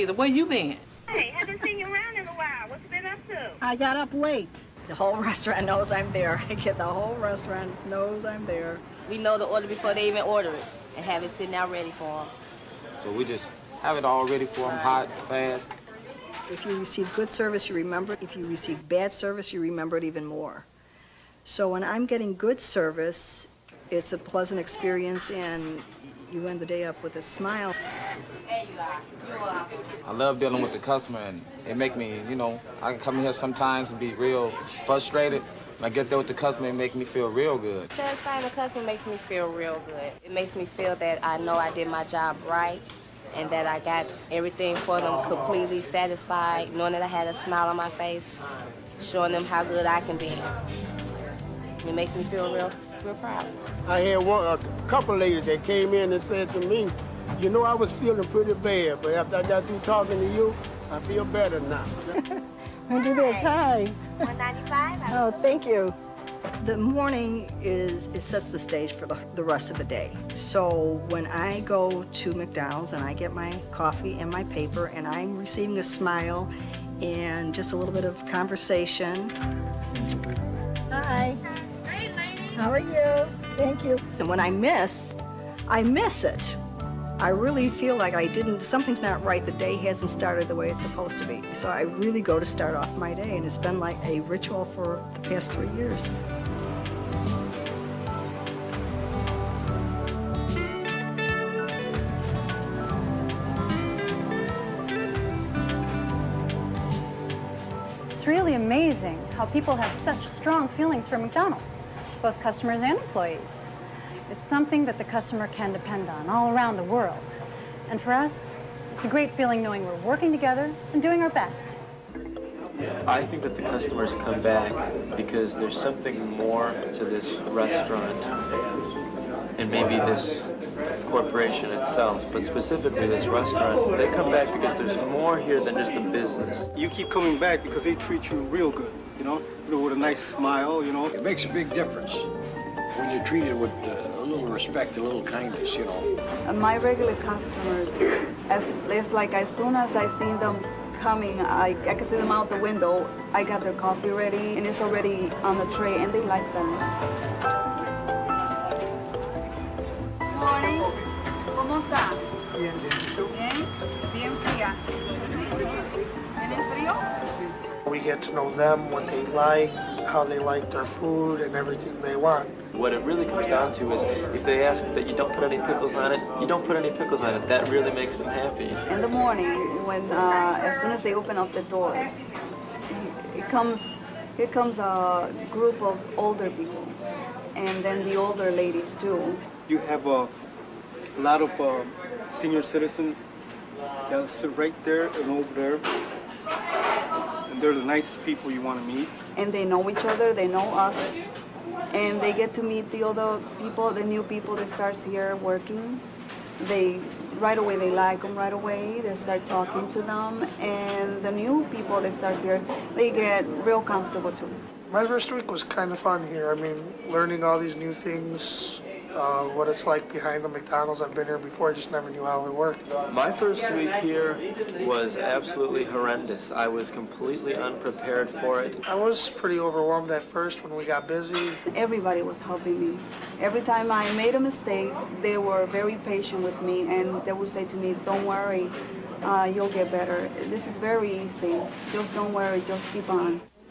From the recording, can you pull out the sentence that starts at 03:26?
They right away they like them right away.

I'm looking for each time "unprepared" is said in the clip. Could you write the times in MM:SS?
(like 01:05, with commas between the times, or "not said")
03:47.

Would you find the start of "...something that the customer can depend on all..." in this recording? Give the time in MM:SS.
01:54.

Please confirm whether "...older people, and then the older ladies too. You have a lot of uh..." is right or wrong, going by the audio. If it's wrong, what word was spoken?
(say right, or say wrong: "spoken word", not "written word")
right.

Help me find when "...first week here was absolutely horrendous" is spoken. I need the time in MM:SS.
03:43.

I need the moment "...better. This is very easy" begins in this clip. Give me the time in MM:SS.
03:59.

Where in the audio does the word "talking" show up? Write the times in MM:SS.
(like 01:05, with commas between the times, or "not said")
00:59, 03:29.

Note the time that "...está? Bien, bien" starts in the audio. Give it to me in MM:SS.
02:41.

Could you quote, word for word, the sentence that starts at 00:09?
We know the order before they even order it, and have it sitting out ready for them.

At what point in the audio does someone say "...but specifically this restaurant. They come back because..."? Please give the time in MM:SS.
02:12.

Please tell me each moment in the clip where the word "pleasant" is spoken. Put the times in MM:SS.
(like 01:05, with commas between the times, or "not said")
00:24.